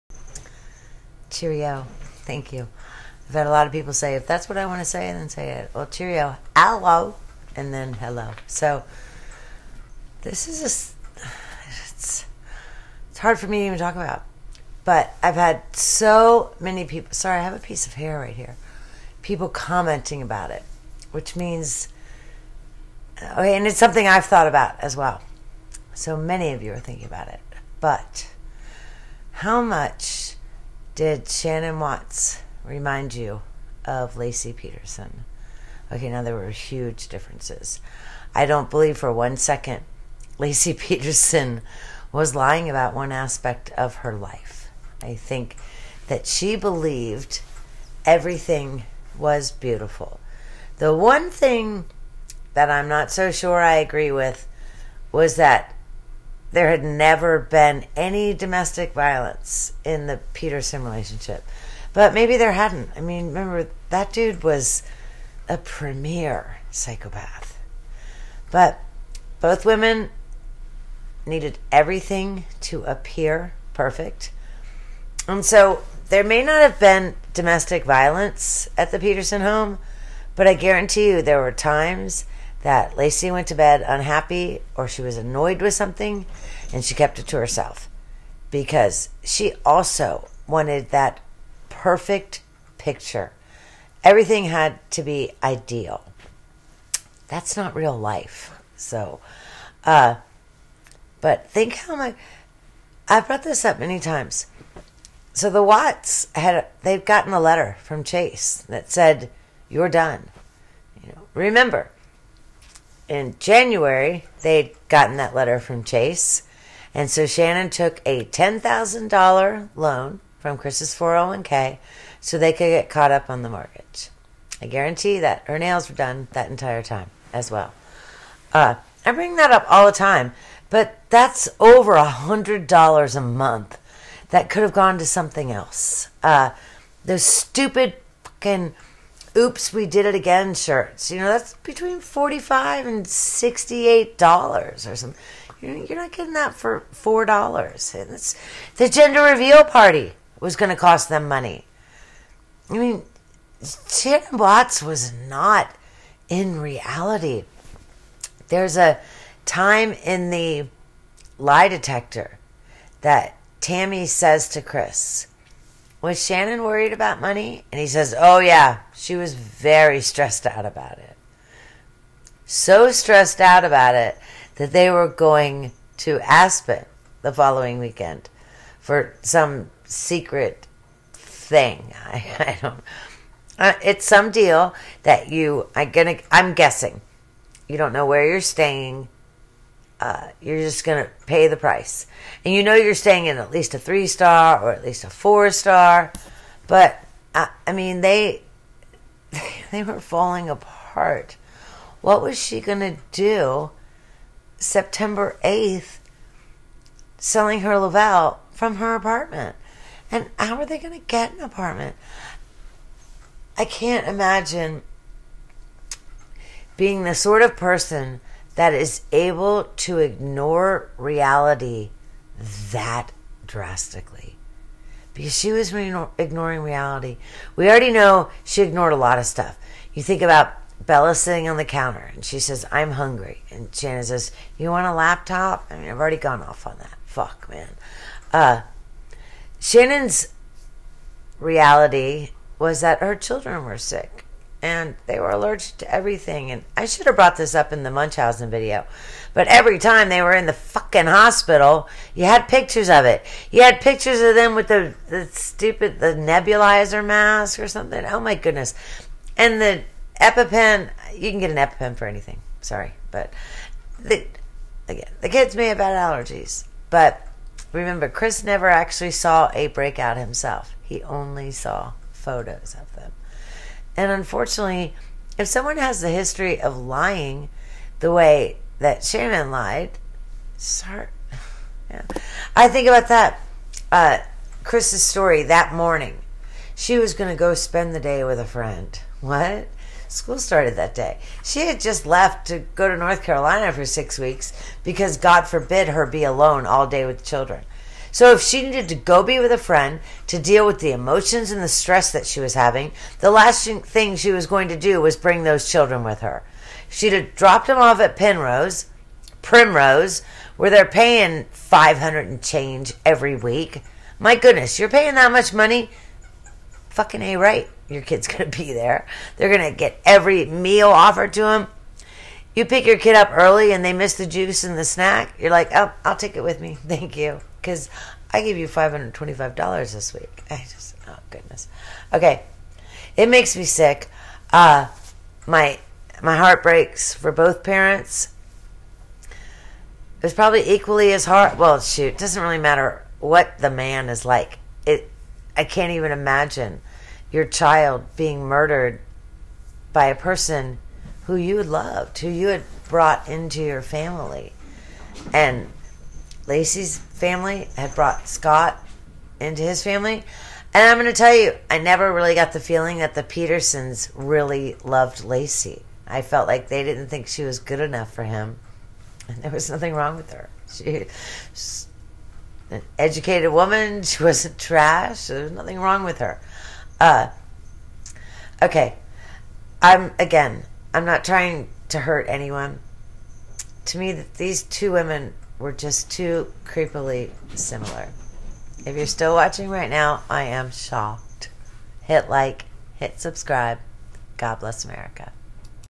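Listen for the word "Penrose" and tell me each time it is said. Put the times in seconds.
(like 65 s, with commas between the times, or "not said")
308 s.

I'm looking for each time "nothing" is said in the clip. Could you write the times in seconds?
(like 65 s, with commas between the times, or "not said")
369 s, 375 s.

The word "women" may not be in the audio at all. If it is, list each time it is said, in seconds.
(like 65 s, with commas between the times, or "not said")
69 s, 384 s.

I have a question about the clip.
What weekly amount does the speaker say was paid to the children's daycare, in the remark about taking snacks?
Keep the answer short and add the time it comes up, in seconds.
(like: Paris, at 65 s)
$525, at 328 s.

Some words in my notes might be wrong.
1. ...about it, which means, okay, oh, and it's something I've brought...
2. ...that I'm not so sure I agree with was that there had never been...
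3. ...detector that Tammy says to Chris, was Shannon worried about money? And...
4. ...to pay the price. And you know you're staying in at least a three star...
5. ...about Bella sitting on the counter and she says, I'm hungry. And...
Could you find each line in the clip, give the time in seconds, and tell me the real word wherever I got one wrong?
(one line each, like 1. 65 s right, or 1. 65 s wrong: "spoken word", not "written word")
1. 20 s wrong: "thought", not "brought"
2. 52 s right
3. 161 s right
4. 191 s right
5. 230 s right.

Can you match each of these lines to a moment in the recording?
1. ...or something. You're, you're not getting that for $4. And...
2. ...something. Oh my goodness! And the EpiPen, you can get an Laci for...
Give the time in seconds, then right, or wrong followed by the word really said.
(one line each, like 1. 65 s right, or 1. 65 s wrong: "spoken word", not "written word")
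1. 144 s right
2. 257 s wrong: "EpiPen", not "Laci".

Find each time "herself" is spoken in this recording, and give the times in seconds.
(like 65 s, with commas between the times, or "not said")
87 s.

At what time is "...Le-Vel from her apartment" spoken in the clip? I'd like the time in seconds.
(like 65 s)
207 s.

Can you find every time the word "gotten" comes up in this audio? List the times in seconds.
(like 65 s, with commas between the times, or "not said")
107 s, 114 s.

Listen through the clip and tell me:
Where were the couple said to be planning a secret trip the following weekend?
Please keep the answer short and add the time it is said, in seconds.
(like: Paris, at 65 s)
Aspen, at 176 s.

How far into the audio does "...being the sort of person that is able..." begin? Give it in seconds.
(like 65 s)
216 s.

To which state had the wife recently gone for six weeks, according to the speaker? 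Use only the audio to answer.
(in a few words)
North Carolina.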